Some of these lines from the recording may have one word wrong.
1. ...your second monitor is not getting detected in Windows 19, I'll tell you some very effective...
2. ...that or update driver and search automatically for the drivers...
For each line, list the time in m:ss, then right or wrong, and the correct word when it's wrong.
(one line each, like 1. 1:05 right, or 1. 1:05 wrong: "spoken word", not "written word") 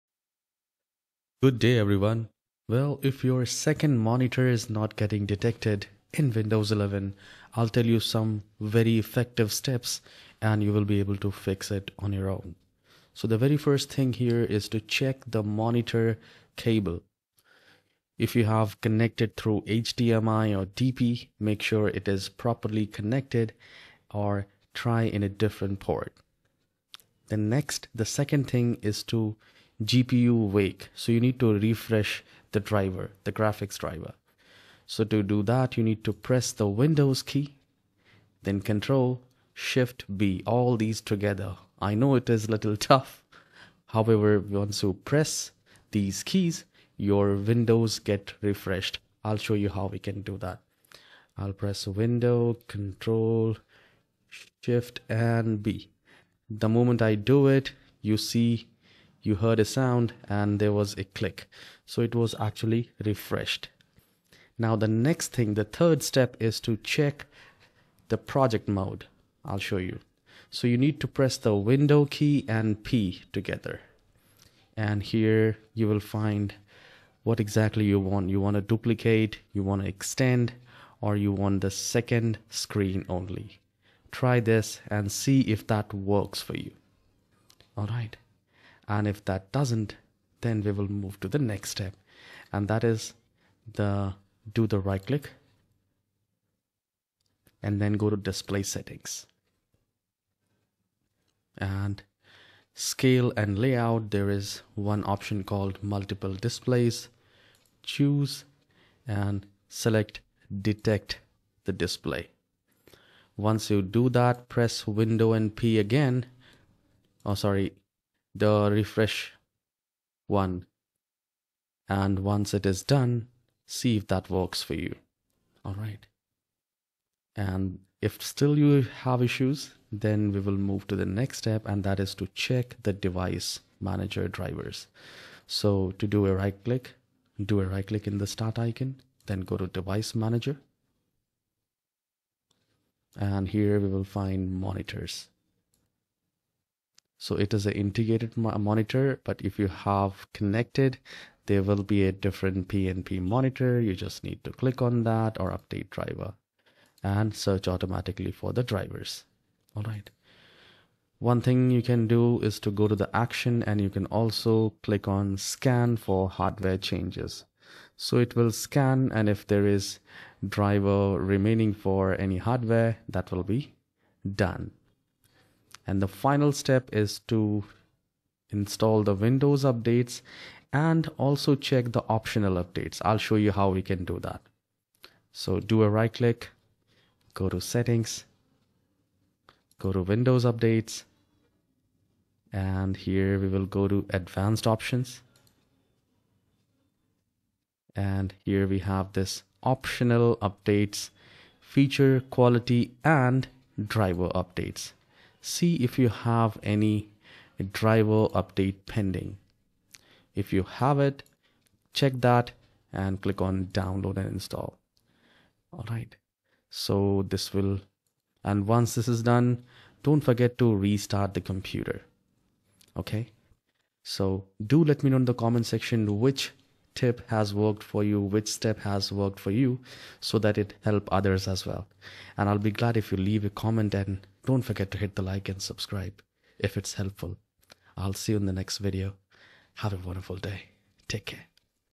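1. 0:03 wrong: "11", not "19"
2. 2:35 right.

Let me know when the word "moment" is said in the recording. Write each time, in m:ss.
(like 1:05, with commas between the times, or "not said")
0:56.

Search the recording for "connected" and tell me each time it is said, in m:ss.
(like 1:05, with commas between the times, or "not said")
0:18, 0:22, 2:30.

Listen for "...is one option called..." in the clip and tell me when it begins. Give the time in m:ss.
1:44.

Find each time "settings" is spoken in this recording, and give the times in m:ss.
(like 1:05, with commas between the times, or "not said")
1:38, 3:07.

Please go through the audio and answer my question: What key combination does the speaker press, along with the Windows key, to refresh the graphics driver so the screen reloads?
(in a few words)
Control Shift B.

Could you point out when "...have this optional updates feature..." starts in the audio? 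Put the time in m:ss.
3:18.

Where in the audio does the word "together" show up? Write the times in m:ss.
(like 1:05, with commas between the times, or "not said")
0:41, 1:13.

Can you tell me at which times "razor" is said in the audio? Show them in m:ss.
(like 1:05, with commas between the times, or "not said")
not said.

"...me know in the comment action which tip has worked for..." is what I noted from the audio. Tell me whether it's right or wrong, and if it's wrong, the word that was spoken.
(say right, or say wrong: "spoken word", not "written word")
wrong: "section", not "action".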